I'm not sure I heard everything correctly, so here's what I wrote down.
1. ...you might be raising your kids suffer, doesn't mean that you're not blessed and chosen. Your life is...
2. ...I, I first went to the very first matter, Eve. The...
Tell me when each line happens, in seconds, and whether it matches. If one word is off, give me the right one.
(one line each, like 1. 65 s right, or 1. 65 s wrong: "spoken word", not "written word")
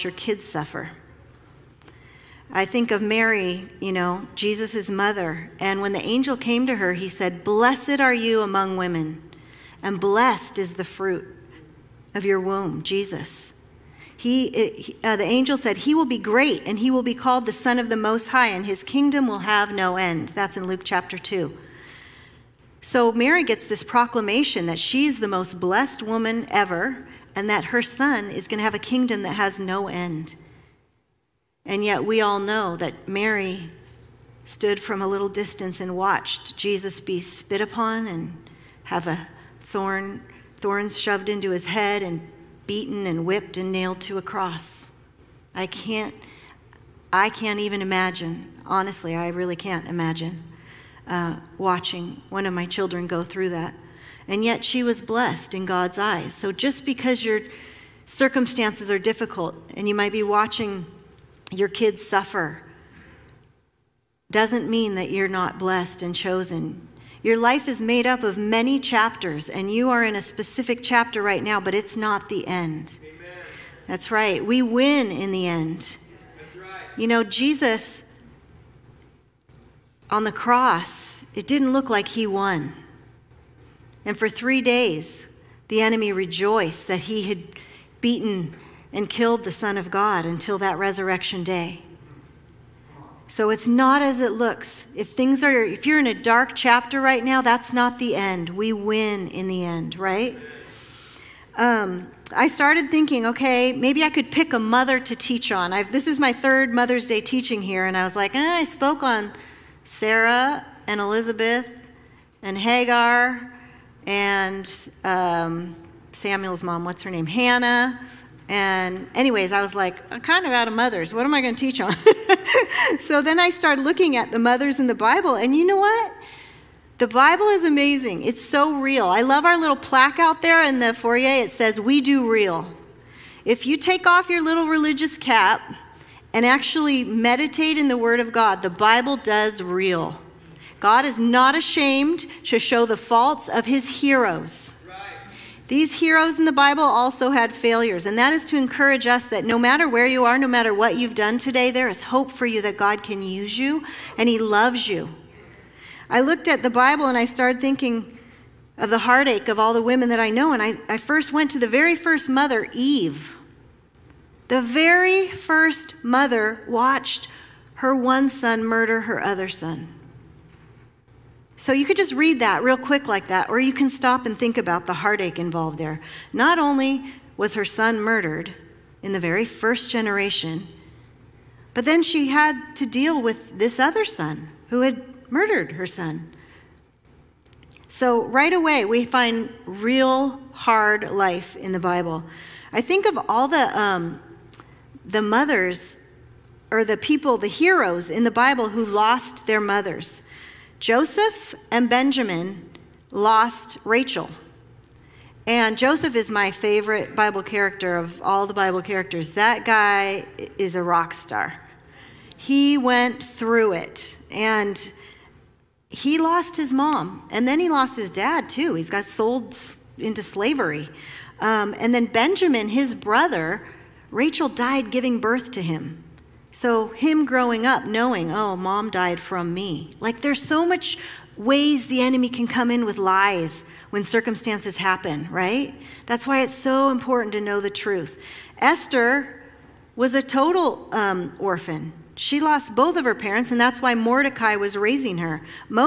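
1. 59 s wrong: "watching", not "raising"
2. 160 s wrong: "mother", not "matter".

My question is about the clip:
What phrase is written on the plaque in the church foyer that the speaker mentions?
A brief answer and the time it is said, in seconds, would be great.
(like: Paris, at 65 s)
We do real, at 131 s.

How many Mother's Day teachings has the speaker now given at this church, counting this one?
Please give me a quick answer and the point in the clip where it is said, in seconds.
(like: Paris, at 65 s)
3, at 106 s.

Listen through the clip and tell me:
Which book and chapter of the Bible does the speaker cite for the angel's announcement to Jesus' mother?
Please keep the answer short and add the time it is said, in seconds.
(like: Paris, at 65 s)
Luke chapter 2, at 20 s.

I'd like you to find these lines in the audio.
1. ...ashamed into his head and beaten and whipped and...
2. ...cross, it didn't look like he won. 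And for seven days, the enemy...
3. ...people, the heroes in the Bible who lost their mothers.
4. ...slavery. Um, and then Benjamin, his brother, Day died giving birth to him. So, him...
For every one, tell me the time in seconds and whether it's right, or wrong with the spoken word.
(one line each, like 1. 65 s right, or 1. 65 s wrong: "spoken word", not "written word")
1. 40 s wrong: "shoved", not "ashamed"
2. 80 s wrong: "three", not "seven"
3. 196 s right
4. 220 s wrong: "Rachel", not "Day".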